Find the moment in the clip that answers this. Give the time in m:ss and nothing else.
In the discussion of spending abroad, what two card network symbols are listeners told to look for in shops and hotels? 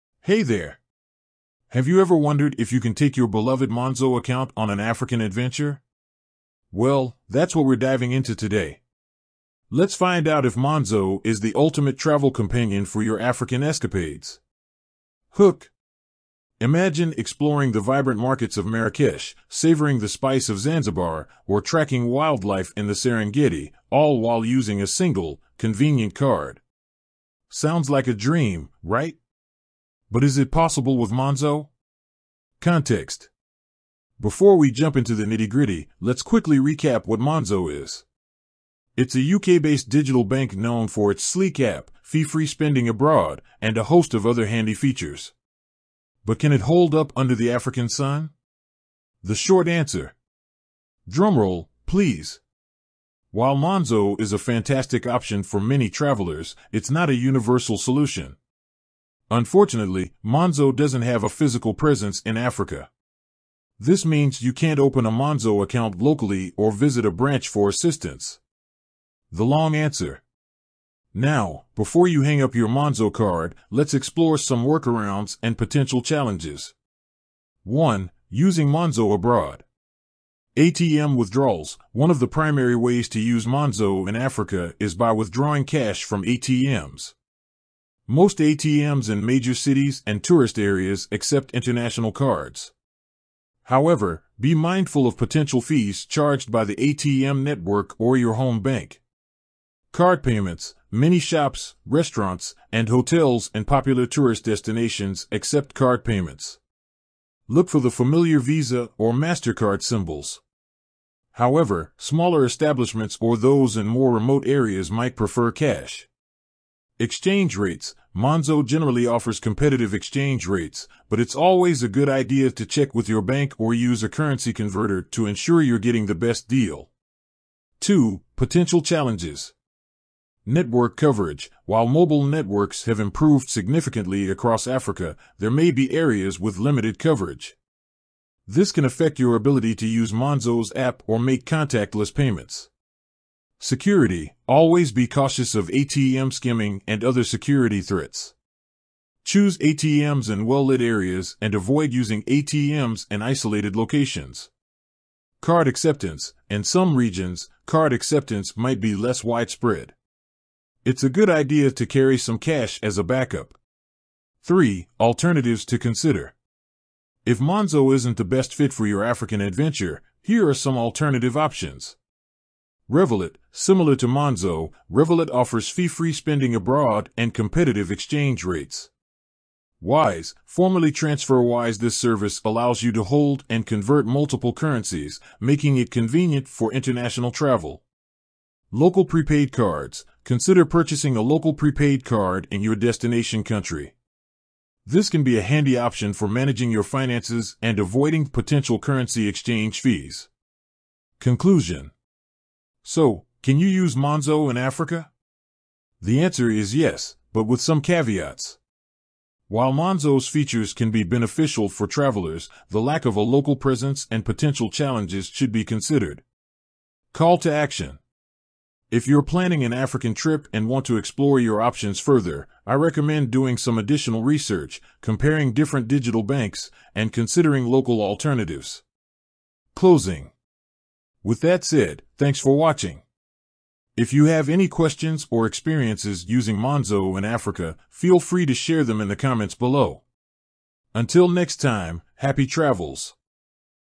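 1:48.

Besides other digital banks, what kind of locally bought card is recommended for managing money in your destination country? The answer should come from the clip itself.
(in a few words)
Local prepaid cards.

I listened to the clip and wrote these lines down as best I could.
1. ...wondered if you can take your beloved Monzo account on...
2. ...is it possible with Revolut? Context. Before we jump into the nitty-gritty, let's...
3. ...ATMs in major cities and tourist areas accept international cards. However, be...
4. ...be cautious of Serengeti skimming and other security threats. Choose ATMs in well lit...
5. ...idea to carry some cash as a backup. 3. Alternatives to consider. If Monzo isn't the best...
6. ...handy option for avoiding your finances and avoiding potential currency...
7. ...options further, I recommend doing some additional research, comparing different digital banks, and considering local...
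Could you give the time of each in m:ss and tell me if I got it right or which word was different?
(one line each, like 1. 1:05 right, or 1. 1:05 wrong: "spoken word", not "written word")
1. 0:02 right
2. 0:30 wrong: "Monzo", not "Revolut"
3. 1:28 right
4. 2:24 wrong: "ATM", not "Serengeti"
5. 2:41 right
6. 3:15 wrong: "managing", not "avoiding"
7. 3:41 right.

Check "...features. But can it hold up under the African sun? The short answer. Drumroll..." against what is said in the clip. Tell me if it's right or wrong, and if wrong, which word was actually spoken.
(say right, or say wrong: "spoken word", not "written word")
right.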